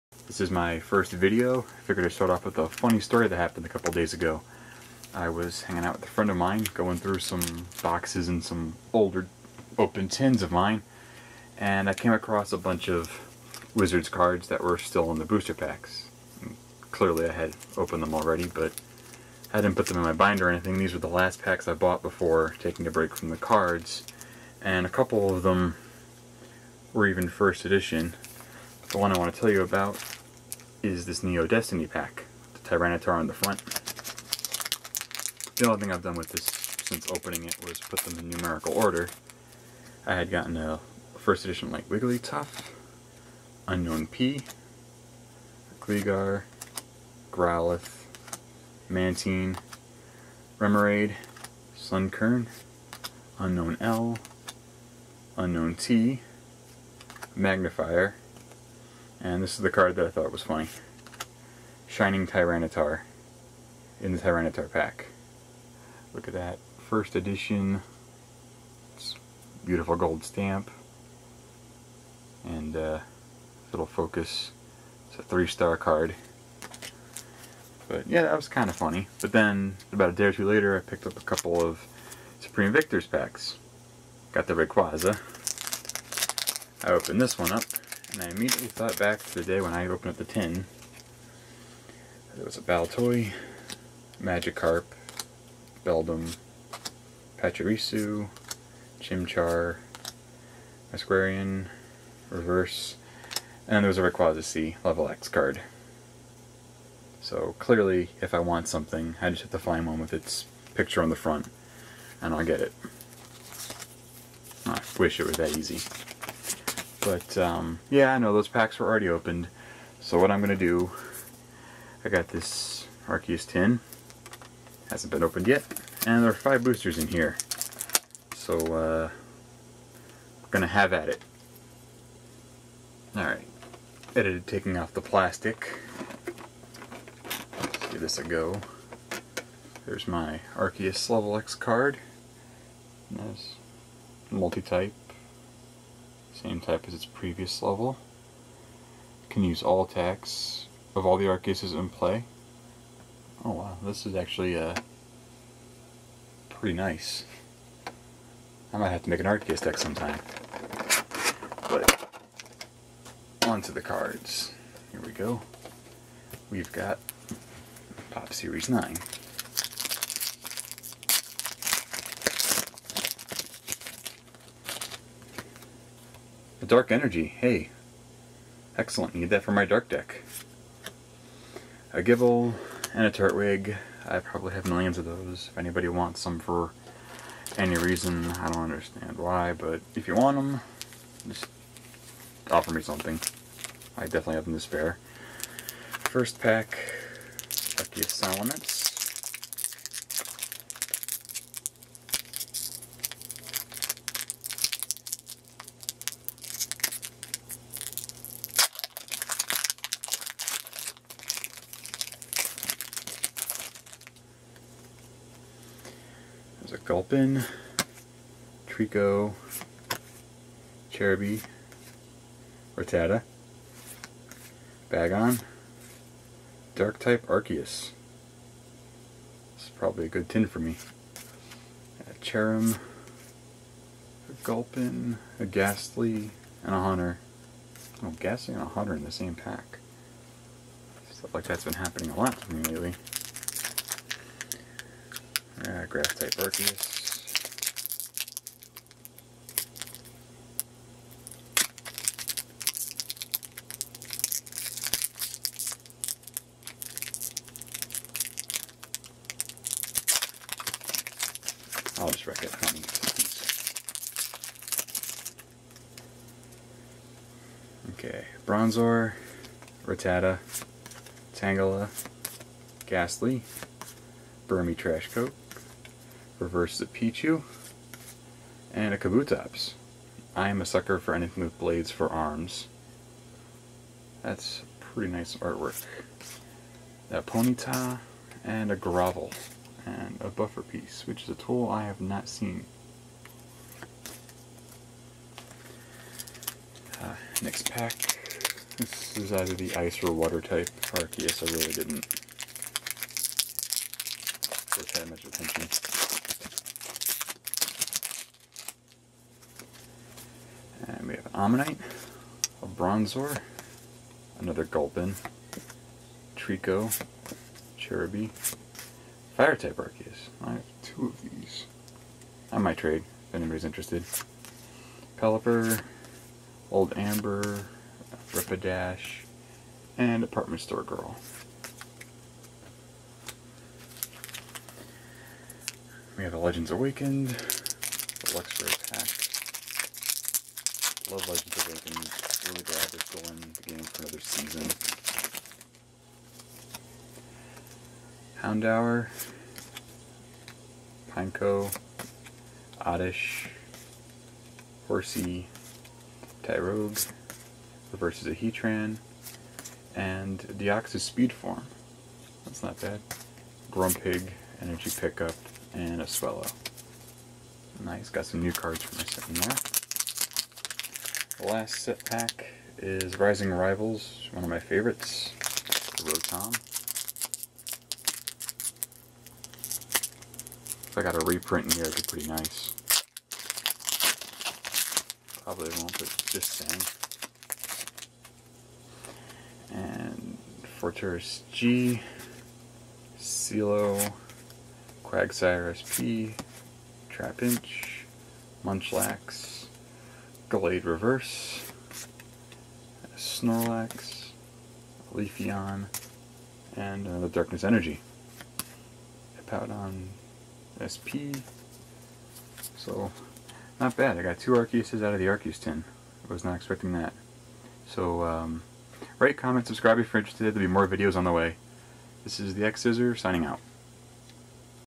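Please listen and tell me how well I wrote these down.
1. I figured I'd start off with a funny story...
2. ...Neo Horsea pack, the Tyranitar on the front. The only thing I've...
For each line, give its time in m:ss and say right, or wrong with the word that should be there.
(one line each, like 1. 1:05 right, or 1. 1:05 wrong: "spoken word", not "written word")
1. 0:01 right
2. 0:31 wrong: "Destiny", not "Horsea".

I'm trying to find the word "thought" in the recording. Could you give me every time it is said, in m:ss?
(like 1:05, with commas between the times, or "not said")
1:00, 1:28.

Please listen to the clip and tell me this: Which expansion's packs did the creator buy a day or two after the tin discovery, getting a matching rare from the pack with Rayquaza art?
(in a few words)
Supreme Victors.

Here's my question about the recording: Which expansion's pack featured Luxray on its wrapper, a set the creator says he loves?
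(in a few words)
Legends Awakened.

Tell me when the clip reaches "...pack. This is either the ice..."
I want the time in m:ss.
4:57.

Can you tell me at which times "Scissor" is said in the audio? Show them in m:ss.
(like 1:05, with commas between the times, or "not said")
7:02.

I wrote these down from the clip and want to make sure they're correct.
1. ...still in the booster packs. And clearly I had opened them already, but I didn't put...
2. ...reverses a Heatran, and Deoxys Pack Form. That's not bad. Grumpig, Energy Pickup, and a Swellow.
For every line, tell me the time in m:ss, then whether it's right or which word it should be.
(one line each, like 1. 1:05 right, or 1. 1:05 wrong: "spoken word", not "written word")
1. 0:14 right
2. 5:57 wrong: "Speed", not "Pack".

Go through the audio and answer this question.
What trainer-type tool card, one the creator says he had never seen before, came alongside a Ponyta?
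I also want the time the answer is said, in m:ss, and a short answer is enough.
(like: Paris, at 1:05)
Buffer piece, at 4:50.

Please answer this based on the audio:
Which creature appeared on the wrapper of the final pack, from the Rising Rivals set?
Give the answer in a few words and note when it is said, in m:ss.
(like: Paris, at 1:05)
Rotom, at 6:16.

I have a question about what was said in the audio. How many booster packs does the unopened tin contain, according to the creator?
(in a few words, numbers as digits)
5.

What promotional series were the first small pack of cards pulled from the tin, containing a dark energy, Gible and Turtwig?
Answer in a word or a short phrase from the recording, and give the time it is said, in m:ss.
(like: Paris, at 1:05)
Pop Series 9, at 2:48.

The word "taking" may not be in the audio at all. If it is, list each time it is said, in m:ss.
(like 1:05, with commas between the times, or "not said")
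0:22, 2:14.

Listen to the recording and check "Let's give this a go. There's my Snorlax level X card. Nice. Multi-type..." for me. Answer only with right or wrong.
wrong.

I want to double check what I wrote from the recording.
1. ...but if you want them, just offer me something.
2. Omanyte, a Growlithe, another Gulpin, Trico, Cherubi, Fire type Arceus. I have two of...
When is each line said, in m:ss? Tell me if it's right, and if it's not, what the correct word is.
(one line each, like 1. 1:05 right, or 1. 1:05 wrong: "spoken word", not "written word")
1. 3:09 right
2. 5:11 wrong: "Bronzor", not "Growlithe".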